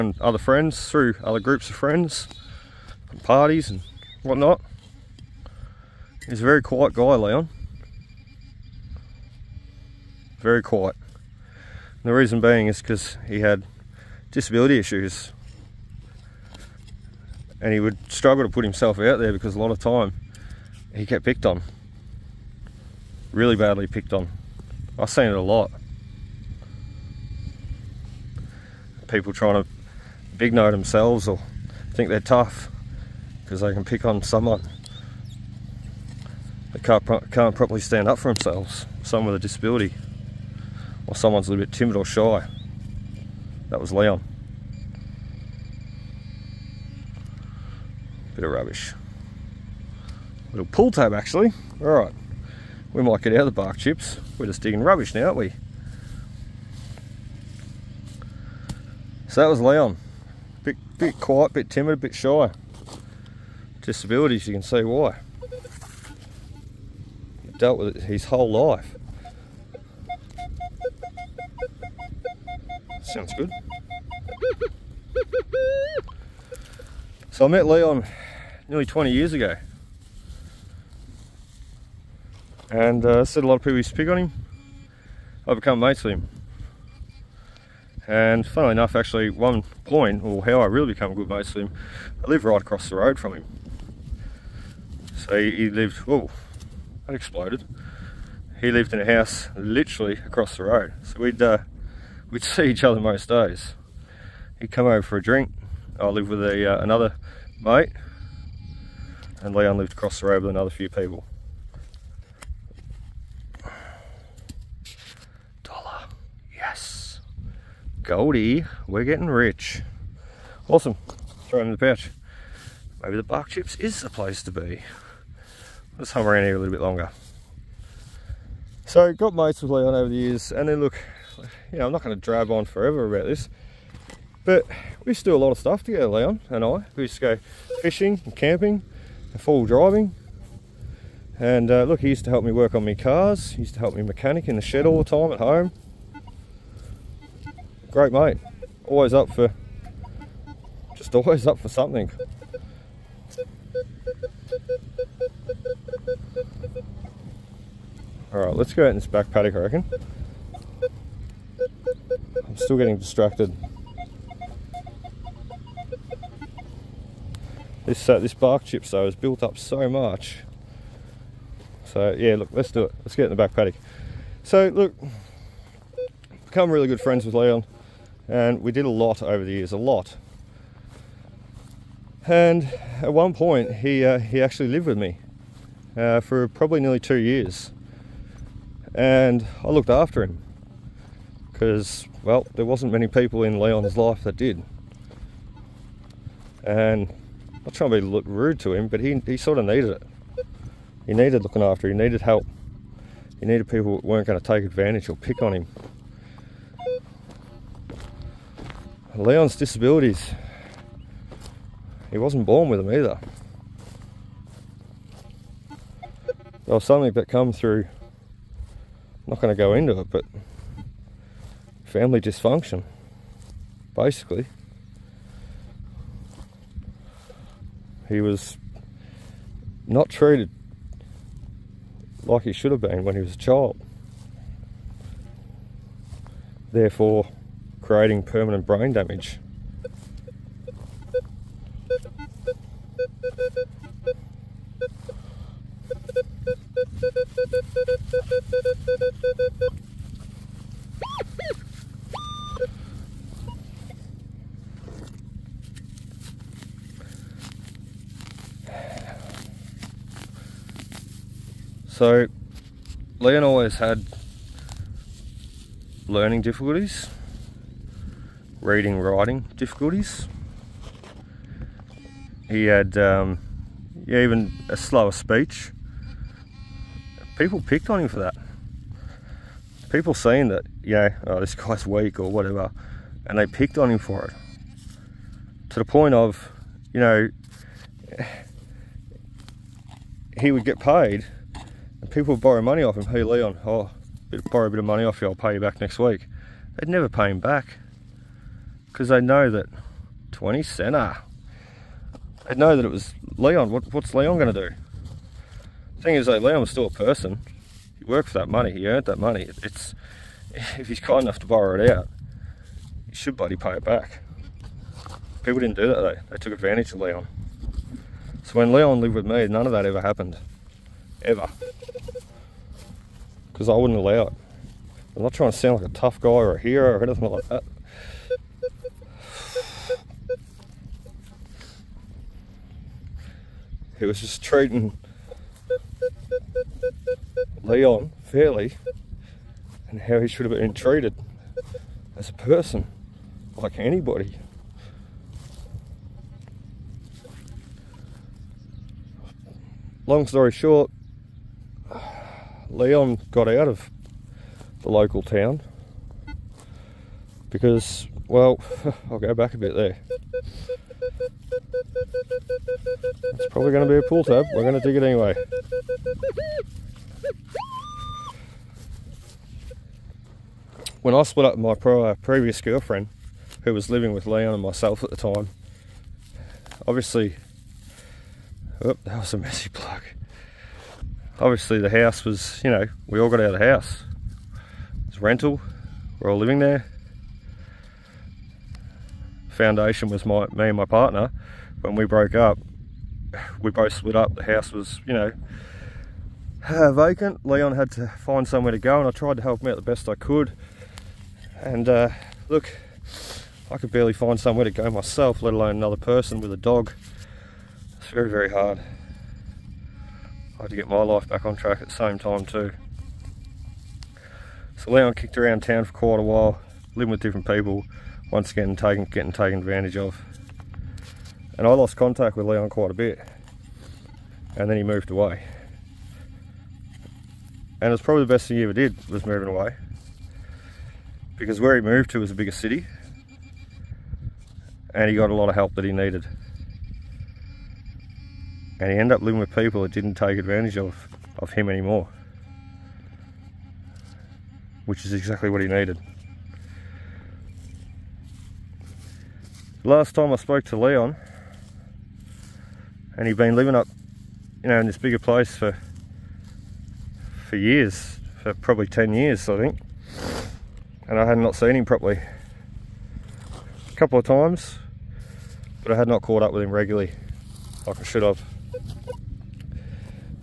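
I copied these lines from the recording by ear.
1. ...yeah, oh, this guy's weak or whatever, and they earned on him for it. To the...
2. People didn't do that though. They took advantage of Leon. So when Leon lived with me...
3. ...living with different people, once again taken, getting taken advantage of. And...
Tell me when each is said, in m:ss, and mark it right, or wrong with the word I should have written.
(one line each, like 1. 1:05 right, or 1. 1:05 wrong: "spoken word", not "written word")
1. 4:40 wrong: "picked", not "earned"
2. 5:15 right
3. 6:56 right.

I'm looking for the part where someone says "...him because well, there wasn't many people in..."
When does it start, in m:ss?
3:10.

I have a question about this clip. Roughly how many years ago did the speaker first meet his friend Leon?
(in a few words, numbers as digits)
20.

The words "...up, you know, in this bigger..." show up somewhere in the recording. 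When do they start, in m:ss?
7:33.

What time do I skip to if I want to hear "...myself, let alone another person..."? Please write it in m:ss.
6:44.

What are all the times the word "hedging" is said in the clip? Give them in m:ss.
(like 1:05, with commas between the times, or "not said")
not said.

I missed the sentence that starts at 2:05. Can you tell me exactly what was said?
Let's hum around here a little bit longer.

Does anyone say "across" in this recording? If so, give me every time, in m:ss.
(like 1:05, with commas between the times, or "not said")
1:32, 1:40, 1:49.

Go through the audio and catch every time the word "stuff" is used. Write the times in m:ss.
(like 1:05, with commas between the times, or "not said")
2:15.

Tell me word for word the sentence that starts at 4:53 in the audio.
Hey Leon, oh, borrow a bit of money off you, I'll pay you back next week.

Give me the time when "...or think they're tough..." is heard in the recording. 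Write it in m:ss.
0:31.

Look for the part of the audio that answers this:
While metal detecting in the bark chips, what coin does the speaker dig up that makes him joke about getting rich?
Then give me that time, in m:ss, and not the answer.
1:55.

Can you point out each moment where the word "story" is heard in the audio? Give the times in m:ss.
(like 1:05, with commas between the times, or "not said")
5:50.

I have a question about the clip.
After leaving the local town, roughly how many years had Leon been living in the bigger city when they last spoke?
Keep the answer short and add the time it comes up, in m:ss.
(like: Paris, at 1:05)
10, at 7:38.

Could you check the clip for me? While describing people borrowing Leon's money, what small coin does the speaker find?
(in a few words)
20 cents.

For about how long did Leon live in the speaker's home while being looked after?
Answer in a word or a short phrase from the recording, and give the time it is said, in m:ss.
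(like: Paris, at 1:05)
2 years, at 3:06.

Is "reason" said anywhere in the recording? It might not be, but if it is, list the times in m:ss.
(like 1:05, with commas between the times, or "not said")
0:12.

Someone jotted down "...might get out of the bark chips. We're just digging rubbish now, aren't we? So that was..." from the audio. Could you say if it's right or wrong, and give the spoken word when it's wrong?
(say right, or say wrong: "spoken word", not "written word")
right.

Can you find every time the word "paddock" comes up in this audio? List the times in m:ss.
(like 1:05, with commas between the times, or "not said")
2:39, 2:53.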